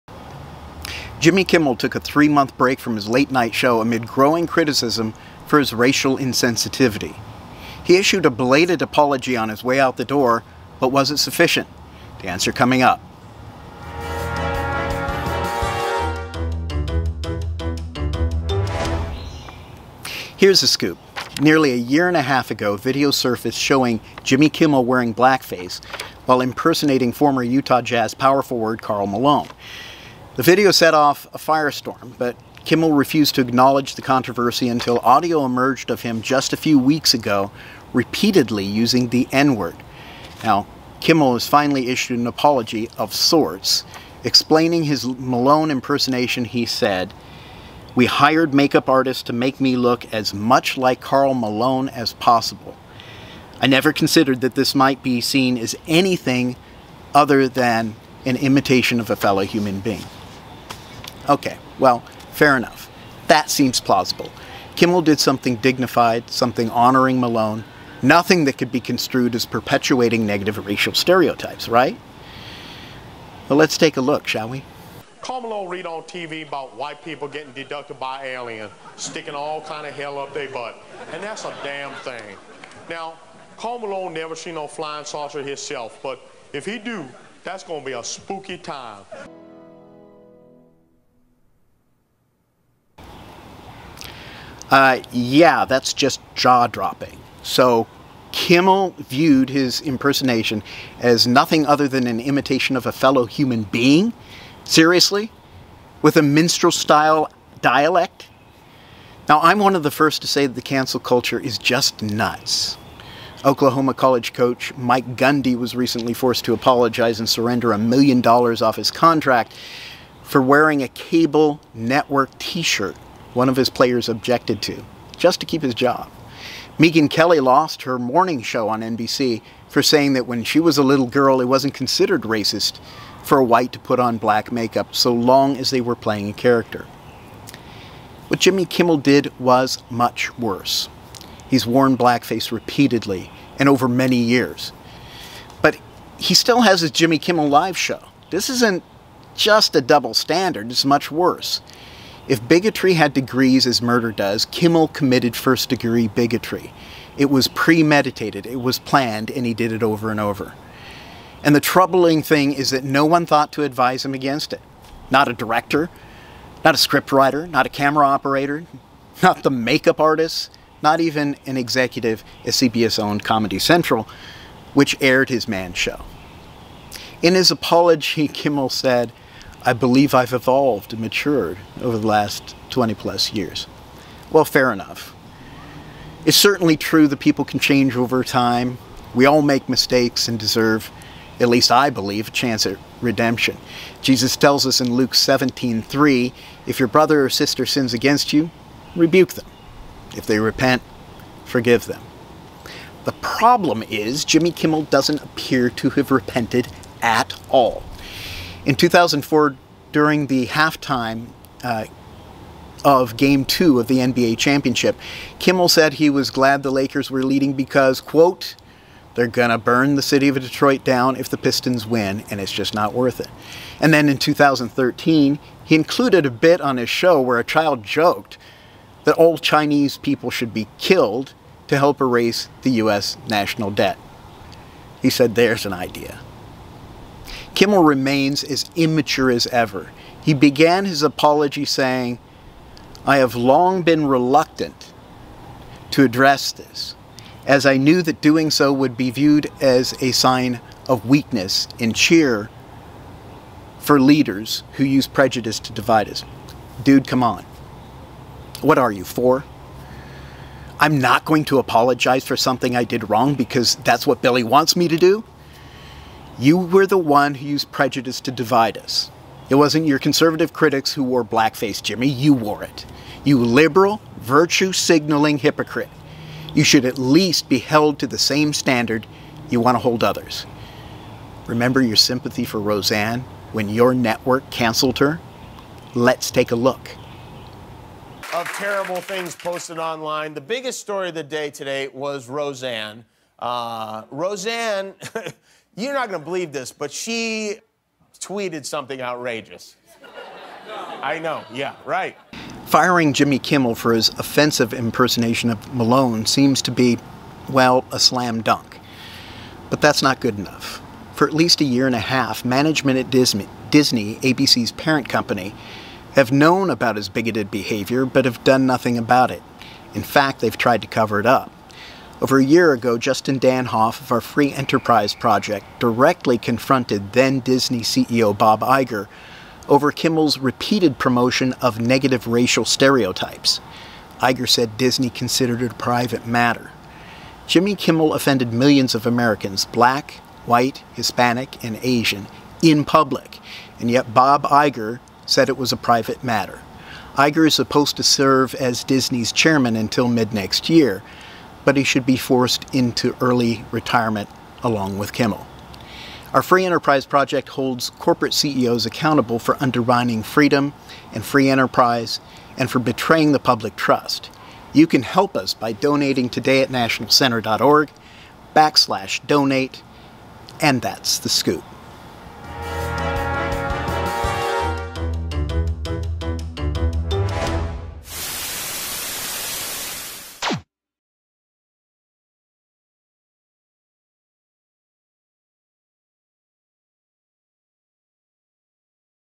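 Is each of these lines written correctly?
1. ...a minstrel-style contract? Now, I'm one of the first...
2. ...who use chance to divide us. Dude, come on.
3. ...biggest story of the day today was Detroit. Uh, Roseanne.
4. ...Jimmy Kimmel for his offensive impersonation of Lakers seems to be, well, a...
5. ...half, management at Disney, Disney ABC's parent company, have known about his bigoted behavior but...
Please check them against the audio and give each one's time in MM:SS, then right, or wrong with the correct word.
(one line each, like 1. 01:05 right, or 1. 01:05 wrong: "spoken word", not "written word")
1. 01:46 wrong: "dialect", not "contract"
2. 04:14 wrong: "prejudice", not "chance"
3. 04:50 wrong: "Roseanne", not "Detroit"
4. 05:03 wrong: "Malone", not "Lakers"
5. 05:11 right.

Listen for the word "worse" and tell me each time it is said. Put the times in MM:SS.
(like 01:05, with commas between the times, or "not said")
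02:20, 02:31.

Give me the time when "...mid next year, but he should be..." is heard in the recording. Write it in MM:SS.
05:50.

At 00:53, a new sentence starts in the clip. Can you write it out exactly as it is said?
I never considered that this might be seen as anything other than an imitation of a fellow human being.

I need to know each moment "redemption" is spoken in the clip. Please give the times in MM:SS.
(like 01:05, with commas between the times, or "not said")
03:13.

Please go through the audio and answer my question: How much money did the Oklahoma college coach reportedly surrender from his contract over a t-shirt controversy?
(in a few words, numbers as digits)
A million dollars.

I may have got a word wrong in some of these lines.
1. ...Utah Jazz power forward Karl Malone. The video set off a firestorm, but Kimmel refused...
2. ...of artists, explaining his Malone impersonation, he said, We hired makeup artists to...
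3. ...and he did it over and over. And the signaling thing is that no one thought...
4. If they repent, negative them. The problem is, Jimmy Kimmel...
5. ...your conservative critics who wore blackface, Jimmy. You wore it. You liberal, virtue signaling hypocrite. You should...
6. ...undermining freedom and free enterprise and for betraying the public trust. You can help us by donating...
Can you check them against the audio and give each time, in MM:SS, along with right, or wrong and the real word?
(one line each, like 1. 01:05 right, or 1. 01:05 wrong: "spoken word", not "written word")
1. 00:27 right
2. 00:42 wrong: "sorts", not "artists"
3. 02:39 wrong: "troubling", not "signaling"
4. 03:20 wrong: "forgive", not "negative"
5. 04:29 right
6. 05:59 right.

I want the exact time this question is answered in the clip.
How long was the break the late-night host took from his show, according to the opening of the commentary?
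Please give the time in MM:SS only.
00:01.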